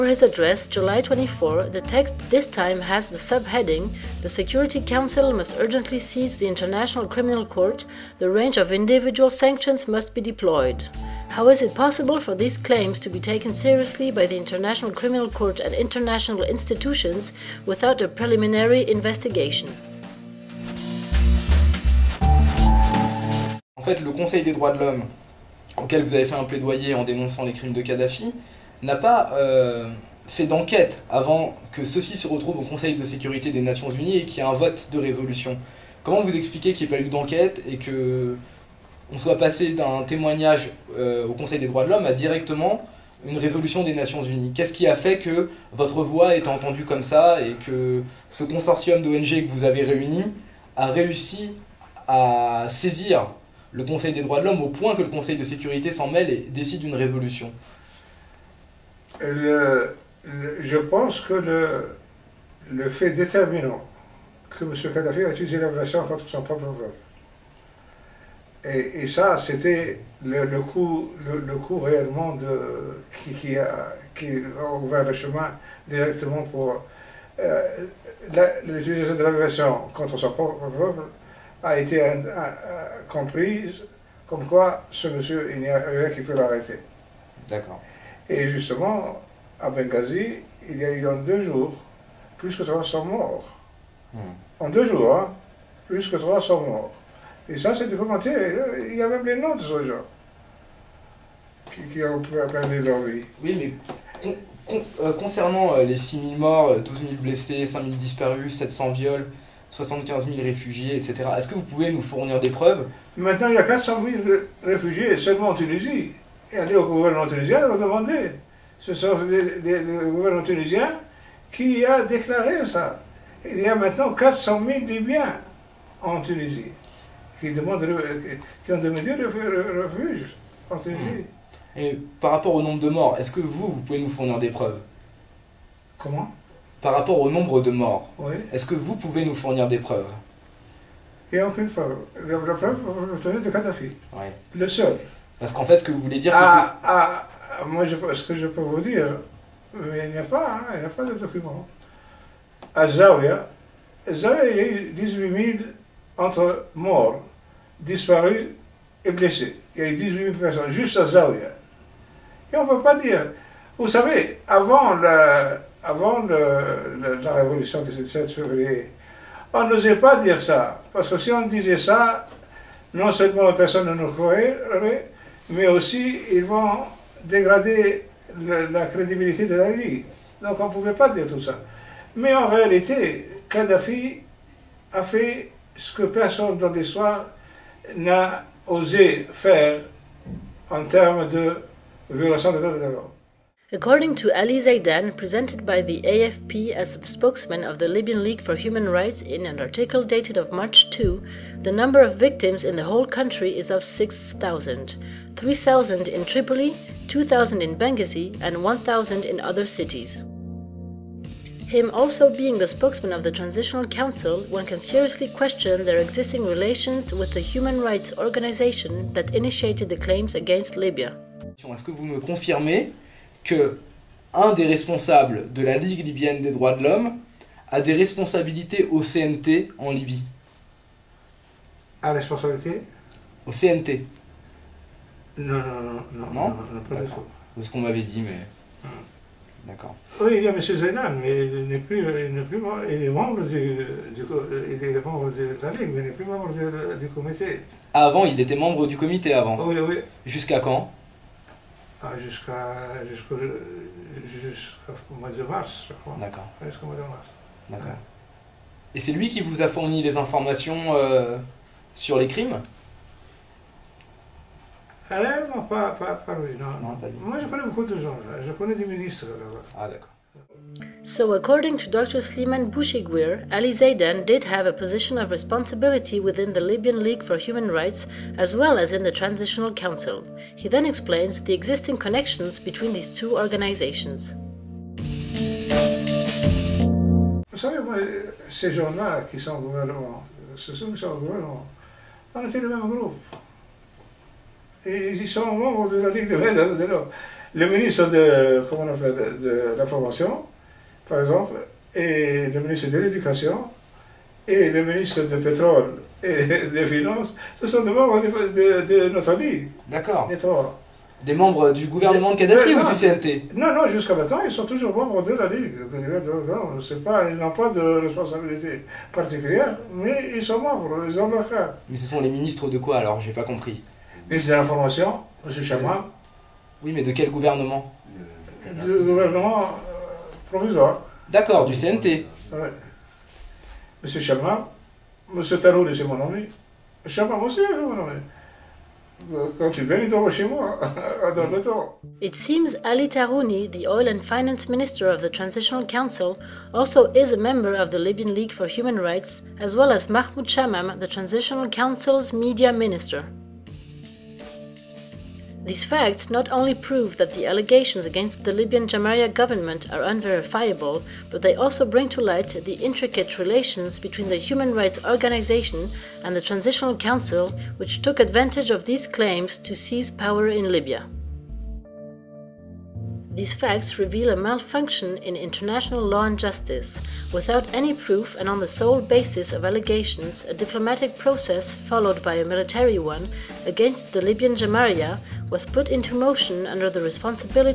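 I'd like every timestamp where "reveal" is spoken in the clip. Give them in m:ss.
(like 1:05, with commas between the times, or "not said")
6:13.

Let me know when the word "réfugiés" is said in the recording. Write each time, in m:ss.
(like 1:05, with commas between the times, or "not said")
1:50, 1:54.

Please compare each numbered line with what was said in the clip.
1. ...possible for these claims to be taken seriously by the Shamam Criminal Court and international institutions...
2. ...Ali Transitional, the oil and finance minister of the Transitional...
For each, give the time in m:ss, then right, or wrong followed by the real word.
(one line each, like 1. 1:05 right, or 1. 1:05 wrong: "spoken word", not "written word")
1. 0:11 wrong: "International", not "Shamam"
2. 5:42 wrong: "Tarouni", not "Transitional".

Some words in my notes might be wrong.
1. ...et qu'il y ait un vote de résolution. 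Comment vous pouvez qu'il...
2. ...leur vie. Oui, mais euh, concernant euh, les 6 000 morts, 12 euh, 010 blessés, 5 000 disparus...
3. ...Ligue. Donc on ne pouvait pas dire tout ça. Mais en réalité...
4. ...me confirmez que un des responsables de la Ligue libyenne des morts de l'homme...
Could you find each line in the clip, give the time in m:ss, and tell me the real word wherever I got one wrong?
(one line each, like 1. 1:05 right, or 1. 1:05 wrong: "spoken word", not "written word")
1. 0:34 wrong: "expliquez", not "pouvez"
2. 1:42 wrong: "000", not "010"
3. 2:59 right
4. 3:42 wrong: "droits", not "morts".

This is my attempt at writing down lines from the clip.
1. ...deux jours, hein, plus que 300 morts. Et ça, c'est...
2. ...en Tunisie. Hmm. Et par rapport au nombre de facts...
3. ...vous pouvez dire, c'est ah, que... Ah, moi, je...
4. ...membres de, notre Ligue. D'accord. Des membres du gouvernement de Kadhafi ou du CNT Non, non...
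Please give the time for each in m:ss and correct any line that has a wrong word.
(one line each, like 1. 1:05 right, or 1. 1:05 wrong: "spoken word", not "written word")
1. 1:34 right
2. 2:10 wrong: "morts", not "facts"
3. 2:25 wrong: "voulez", not "pouvez"
4. 5:07 right.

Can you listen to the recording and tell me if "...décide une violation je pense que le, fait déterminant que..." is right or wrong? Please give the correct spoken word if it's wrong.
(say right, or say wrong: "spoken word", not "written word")
wrong: "résolution", not "violation".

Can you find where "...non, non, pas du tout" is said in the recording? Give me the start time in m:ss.
3:56.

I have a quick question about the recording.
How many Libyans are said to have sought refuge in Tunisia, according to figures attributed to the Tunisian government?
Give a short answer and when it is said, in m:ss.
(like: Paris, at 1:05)
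400,000, at 1:53.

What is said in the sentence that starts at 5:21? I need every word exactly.
Mais ce sont les ministres de quoi alors J'ai pas compris.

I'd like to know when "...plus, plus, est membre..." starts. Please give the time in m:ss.
4:01.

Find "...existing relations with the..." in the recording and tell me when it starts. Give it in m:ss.
3:35.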